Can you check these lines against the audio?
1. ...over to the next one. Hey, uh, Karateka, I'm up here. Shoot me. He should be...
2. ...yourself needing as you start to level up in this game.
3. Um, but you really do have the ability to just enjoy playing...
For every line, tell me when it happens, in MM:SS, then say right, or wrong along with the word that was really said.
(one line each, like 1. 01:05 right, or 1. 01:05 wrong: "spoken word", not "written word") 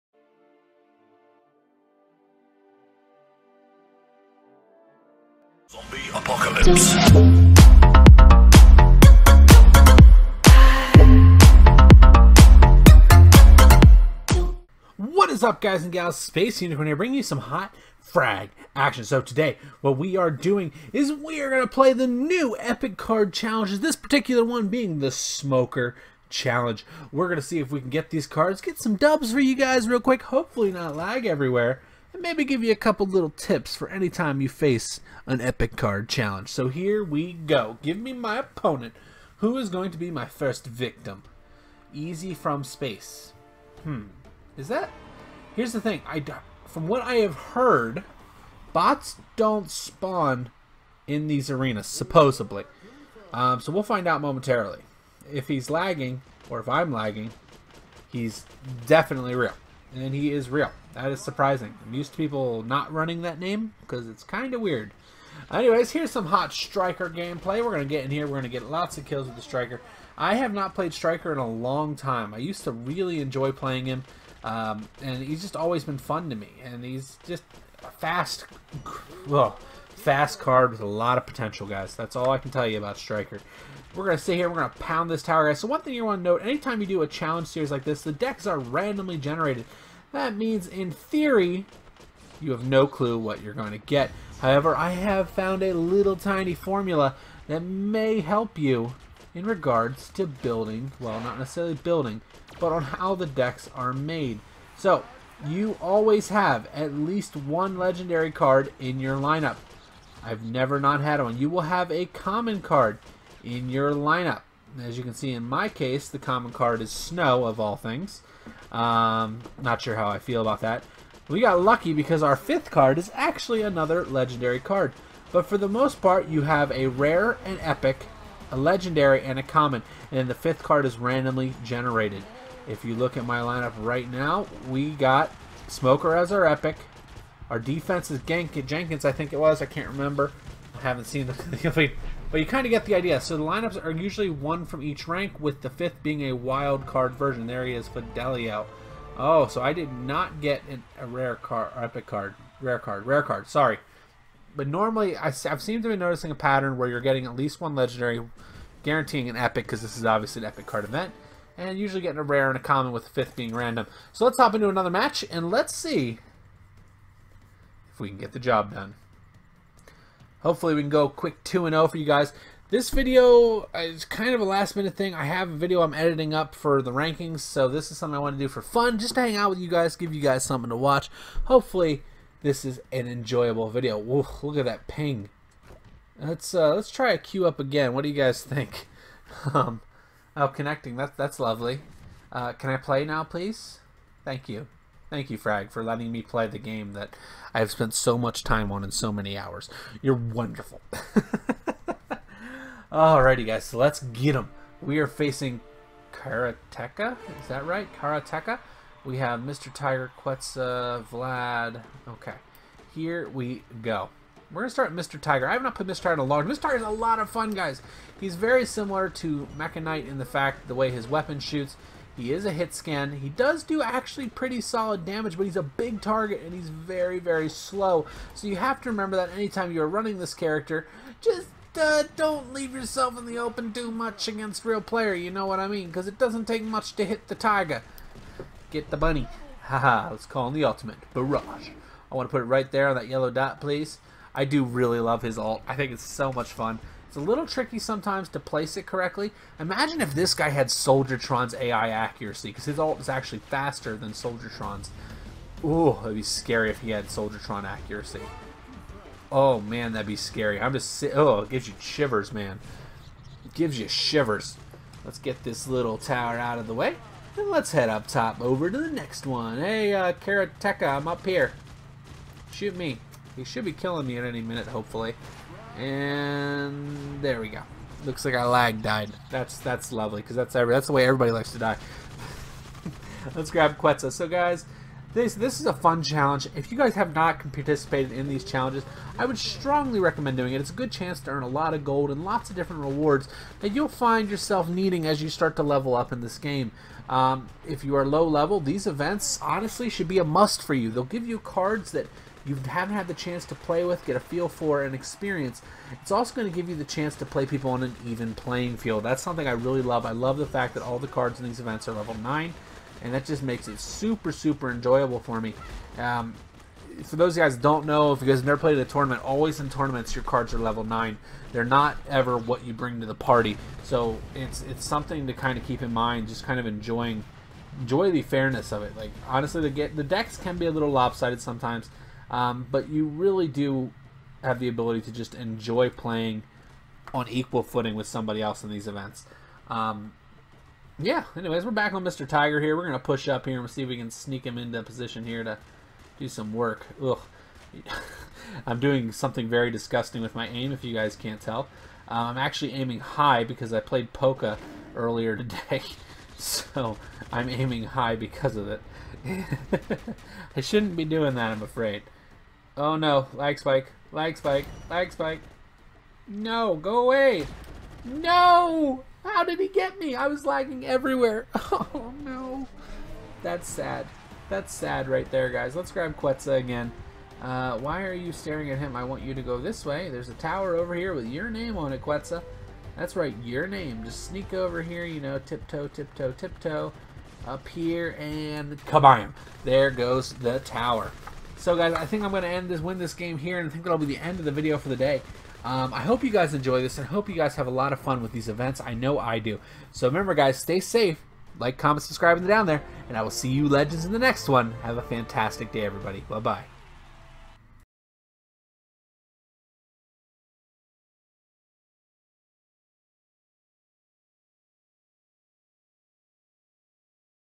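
1. 04:28 right
2. 04:54 right
3. 05:32 right.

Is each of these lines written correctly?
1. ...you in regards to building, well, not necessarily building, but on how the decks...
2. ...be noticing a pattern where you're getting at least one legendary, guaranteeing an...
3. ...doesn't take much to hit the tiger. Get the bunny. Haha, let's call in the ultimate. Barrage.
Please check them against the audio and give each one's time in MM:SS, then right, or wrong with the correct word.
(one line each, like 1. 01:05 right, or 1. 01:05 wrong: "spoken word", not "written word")
1. 01:38 right
2. 02:35 right
3. 03:56 right.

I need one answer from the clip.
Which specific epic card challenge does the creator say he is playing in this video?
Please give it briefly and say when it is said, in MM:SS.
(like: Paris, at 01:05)
Smoker Challenge, at 00:25.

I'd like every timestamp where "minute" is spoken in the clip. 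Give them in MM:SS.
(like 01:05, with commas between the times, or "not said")
02:54, 04:34.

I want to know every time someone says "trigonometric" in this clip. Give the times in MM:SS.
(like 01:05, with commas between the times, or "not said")
not said.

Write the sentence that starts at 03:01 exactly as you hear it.
Hopefully this is an enjoyable video.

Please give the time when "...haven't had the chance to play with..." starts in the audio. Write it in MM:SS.
05:02.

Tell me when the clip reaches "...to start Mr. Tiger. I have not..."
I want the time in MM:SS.
03:34.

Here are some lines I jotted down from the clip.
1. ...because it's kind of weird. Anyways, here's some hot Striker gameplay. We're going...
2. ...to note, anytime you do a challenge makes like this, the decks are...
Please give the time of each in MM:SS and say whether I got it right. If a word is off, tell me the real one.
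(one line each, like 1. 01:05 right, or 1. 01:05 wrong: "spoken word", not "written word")
1. 01:03 right
2. 01:26 wrong: "series", not "makes".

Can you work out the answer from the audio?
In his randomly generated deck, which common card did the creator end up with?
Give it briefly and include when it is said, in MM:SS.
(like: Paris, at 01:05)
Snow, at 01:56.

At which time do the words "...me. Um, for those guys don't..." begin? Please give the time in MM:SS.
05:15.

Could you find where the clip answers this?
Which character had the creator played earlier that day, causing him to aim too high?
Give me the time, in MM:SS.
05:54.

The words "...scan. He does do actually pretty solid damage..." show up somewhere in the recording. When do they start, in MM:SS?
03:42.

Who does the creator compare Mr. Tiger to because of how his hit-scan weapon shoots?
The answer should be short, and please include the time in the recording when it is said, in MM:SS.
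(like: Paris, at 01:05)
Mechanite, at 03:39.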